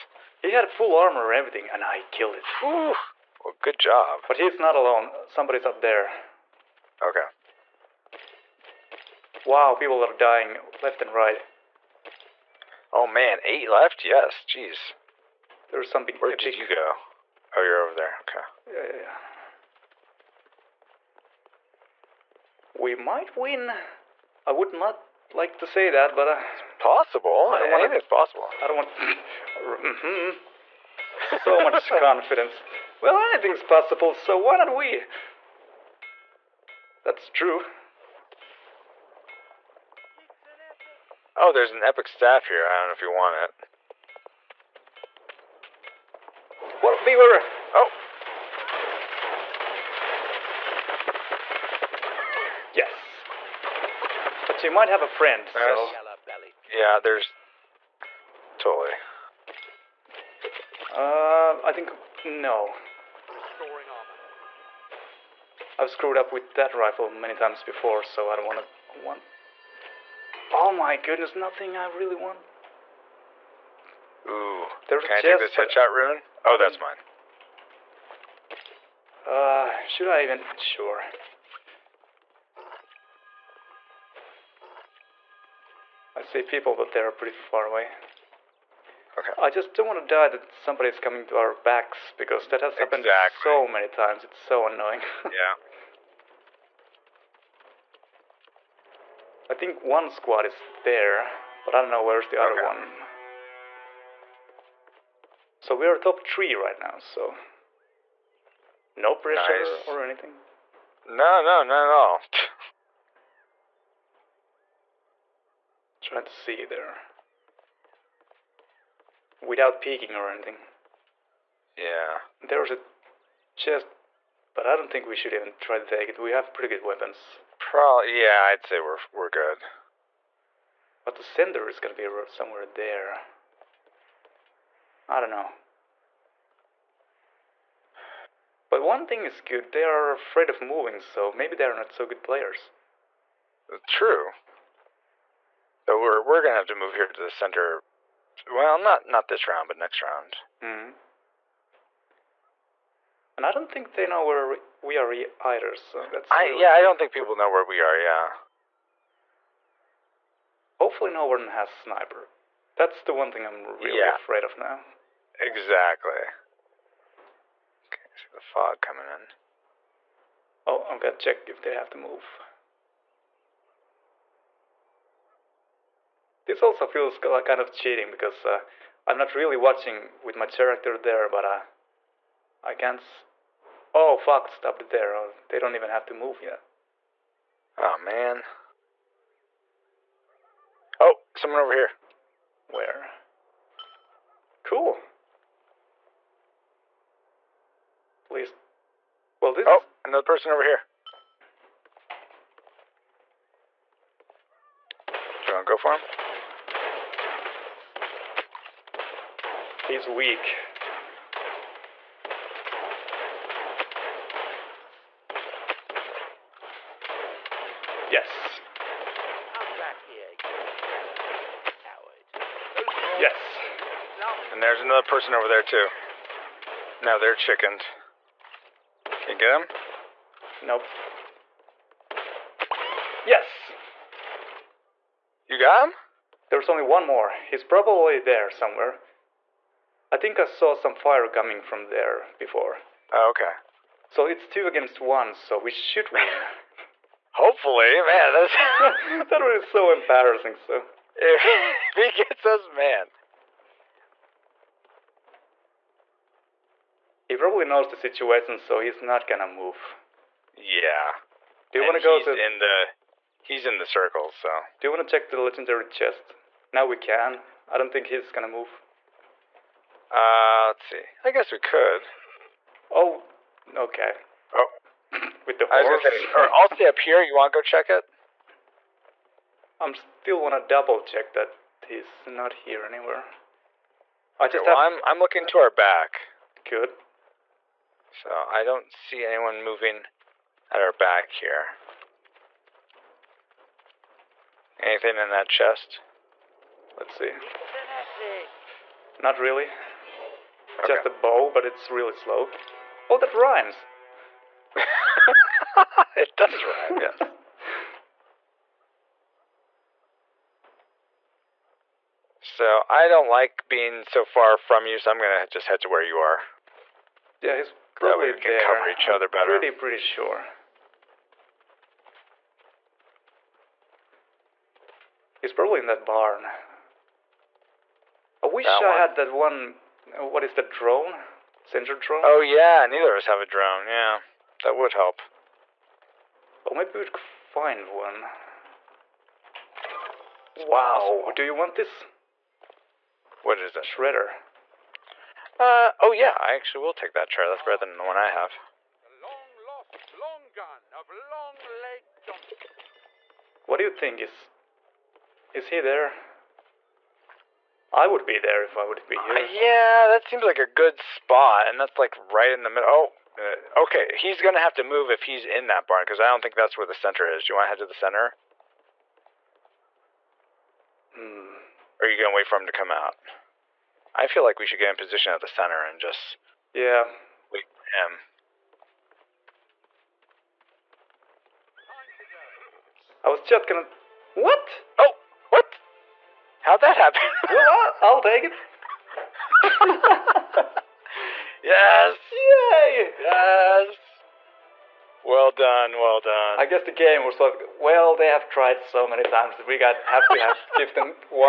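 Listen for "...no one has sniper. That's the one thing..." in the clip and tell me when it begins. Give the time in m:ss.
2:41.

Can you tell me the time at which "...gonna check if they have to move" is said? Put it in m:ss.
2:50.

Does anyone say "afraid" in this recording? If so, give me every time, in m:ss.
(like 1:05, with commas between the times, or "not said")
2:20, 2:44.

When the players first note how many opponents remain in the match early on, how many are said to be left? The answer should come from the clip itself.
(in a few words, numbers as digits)
8.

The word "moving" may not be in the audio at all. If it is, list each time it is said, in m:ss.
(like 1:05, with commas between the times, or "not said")
2:20, 4:49.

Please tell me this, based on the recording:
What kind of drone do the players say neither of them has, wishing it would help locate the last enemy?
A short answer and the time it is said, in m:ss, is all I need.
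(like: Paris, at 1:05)
Sensor drone, at 5:31.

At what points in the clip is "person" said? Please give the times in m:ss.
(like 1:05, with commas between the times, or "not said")
3:20, 3:45.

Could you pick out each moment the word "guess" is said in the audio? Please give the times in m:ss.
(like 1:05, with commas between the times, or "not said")
4:31, 6:36.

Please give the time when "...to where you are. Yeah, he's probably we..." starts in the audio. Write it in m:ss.
5:15.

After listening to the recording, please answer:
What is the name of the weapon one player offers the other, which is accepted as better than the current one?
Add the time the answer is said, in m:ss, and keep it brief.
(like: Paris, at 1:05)
Shredder, at 5:43.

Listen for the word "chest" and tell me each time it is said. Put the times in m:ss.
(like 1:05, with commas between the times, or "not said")
2:03, 4:25, 4:55.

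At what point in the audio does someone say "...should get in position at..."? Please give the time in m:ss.
6:14.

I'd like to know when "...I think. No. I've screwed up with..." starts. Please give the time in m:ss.
1:01.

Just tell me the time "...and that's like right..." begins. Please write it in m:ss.
6:01.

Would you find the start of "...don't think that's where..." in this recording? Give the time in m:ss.
6:06.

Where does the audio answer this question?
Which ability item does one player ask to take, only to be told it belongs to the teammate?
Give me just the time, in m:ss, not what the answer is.
1:15.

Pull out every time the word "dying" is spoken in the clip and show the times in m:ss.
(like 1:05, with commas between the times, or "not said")
0:10.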